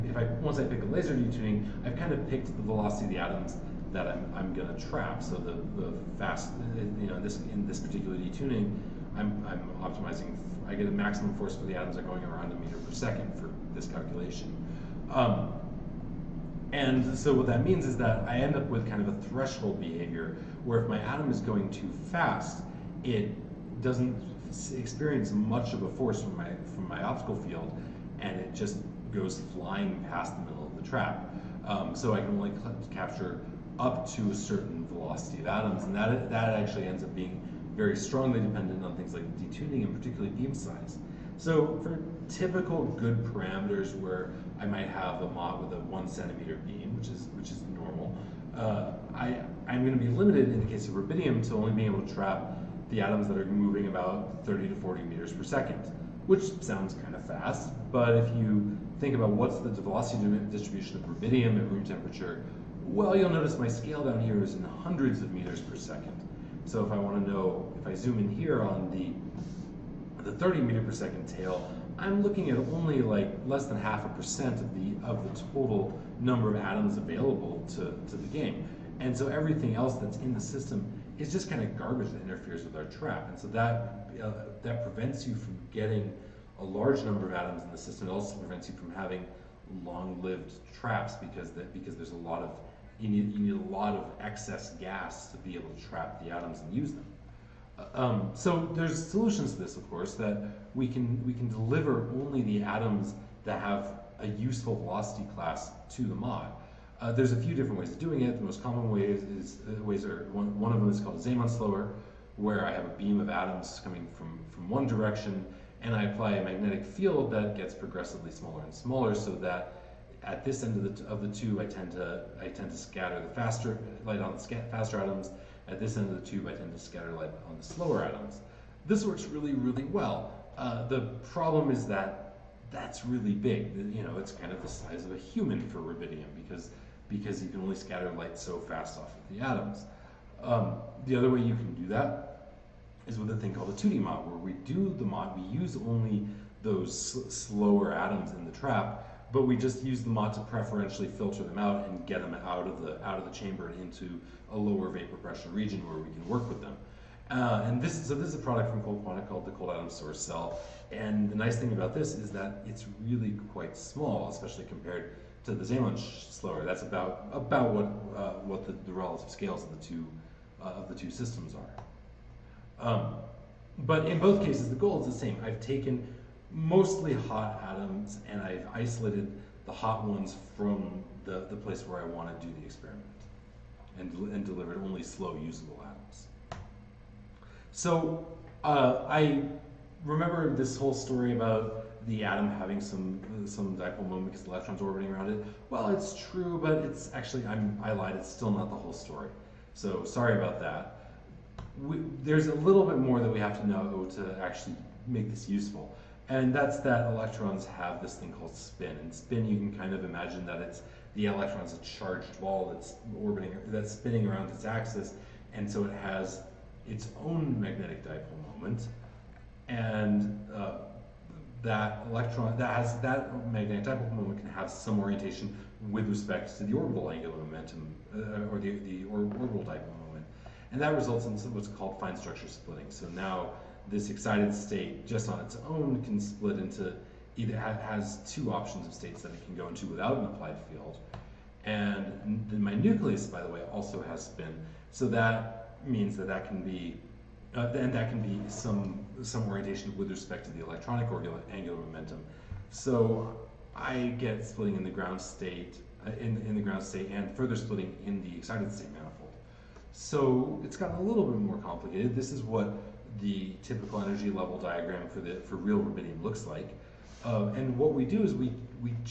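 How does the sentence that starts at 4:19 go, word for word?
So it's gotten a little bit more complicated.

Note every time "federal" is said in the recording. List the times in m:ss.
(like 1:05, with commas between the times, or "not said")
not said.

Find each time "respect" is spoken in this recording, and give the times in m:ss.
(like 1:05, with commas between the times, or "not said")
3:46, 4:10.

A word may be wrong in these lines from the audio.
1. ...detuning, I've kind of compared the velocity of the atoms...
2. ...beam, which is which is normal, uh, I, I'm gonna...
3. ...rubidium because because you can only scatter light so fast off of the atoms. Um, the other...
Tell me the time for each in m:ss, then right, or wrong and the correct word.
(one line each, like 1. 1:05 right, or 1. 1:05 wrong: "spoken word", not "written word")
1. 0:01 wrong: "picked", not "compared"
2. 0:46 right
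3. 2:15 right.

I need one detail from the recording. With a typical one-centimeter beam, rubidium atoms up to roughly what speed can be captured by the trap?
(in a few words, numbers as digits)
30 to 40 meters per second.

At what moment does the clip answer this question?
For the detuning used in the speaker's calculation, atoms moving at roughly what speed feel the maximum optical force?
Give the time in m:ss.
0:12.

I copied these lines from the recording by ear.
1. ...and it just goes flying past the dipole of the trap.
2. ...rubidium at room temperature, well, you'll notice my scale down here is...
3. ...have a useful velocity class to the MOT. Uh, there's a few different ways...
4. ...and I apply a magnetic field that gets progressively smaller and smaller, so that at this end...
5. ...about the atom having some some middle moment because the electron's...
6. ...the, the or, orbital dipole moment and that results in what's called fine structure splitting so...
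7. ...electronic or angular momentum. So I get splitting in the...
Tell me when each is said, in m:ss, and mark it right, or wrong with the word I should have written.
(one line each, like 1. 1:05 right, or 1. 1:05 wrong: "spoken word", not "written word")
1. 0:28 wrong: "middle", not "dipole"
2. 1:01 right
3. 1:43 right
4. 1:55 right
5. 3:11 wrong: "dipole", not "middle"
6. 3:48 right
7. 4:10 right.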